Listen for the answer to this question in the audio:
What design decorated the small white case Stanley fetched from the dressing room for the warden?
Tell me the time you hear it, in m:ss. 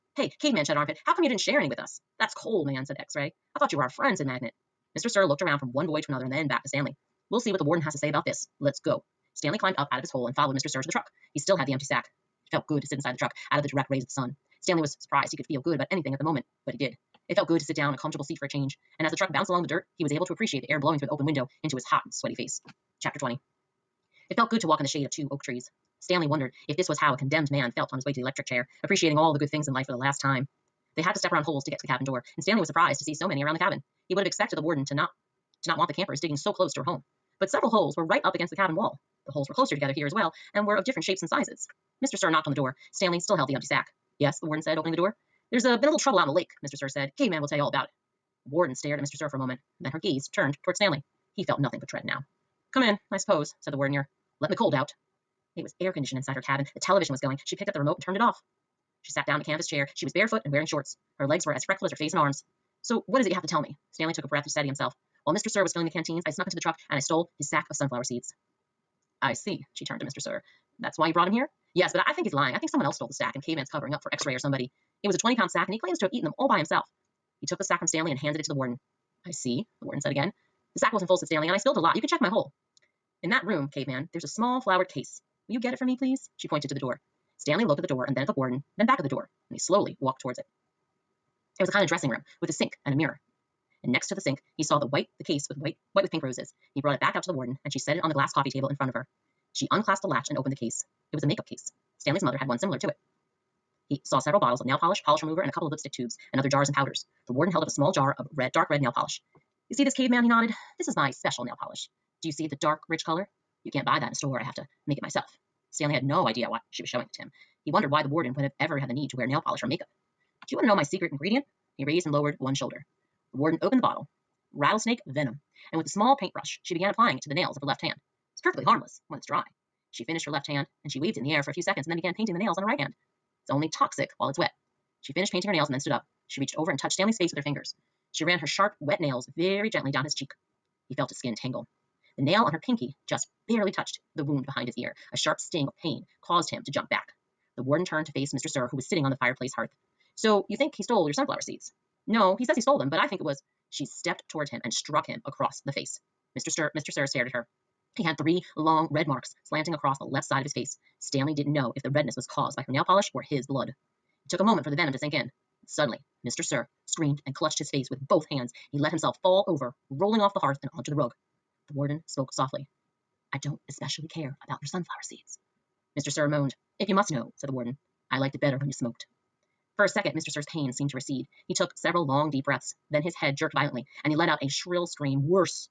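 1:36.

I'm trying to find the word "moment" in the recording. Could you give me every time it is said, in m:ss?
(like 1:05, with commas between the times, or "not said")
0:16, 0:49, 2:44.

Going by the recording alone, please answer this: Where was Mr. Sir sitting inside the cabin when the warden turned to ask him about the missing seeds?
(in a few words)
fireplace hearth.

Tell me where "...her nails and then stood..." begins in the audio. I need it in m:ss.
2:15.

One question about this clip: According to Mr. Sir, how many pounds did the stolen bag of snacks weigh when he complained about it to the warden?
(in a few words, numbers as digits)
20.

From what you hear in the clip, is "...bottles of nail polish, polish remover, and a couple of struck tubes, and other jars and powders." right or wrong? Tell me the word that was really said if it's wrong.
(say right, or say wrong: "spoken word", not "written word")
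wrong: "lipstick", not "struck".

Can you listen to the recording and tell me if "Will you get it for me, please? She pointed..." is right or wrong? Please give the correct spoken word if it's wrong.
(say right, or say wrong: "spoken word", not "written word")
right.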